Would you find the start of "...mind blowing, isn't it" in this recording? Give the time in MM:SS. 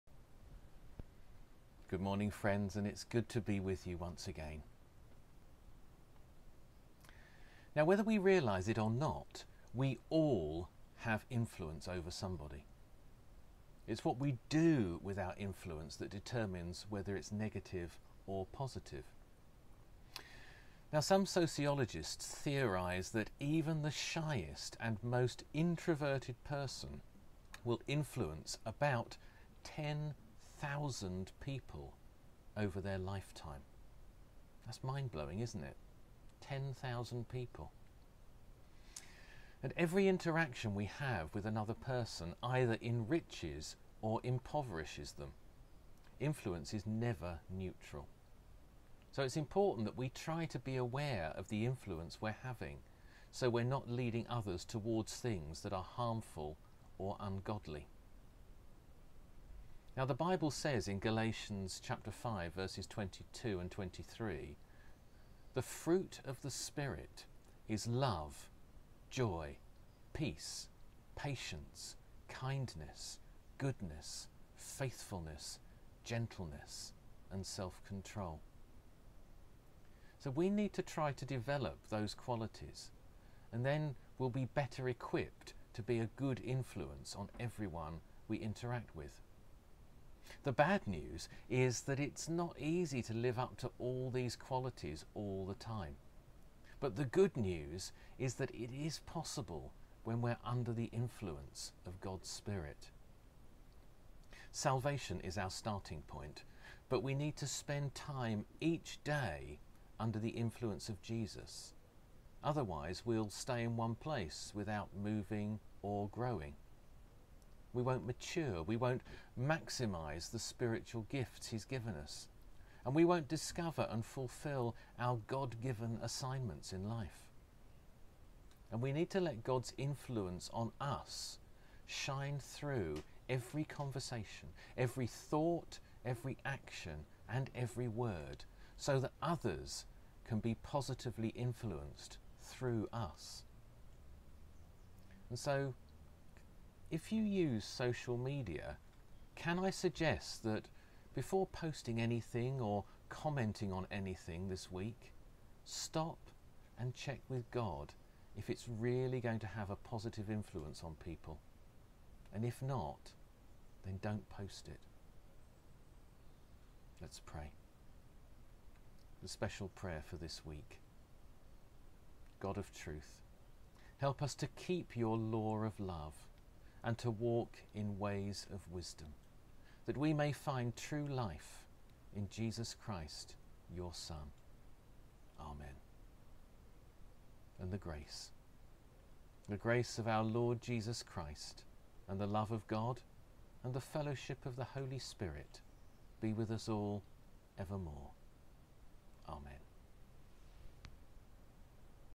00:34.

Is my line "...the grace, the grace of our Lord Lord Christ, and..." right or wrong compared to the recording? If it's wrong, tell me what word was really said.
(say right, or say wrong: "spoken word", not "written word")
wrong: "Jesus", not "Lord".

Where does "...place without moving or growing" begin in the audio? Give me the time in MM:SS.
01:53.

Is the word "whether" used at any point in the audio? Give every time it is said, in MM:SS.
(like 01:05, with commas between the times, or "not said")
00:07, 00:16.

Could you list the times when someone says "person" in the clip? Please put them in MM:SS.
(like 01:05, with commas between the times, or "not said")
00:26, 00:41.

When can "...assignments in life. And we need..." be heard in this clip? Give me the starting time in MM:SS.
02:06.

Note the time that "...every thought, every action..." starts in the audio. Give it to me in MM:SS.
02:14.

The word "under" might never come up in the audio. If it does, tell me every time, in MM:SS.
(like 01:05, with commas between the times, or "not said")
01:40, 01:49.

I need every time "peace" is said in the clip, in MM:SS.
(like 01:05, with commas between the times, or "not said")
01:10.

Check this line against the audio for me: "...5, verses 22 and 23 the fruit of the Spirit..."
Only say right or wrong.
right.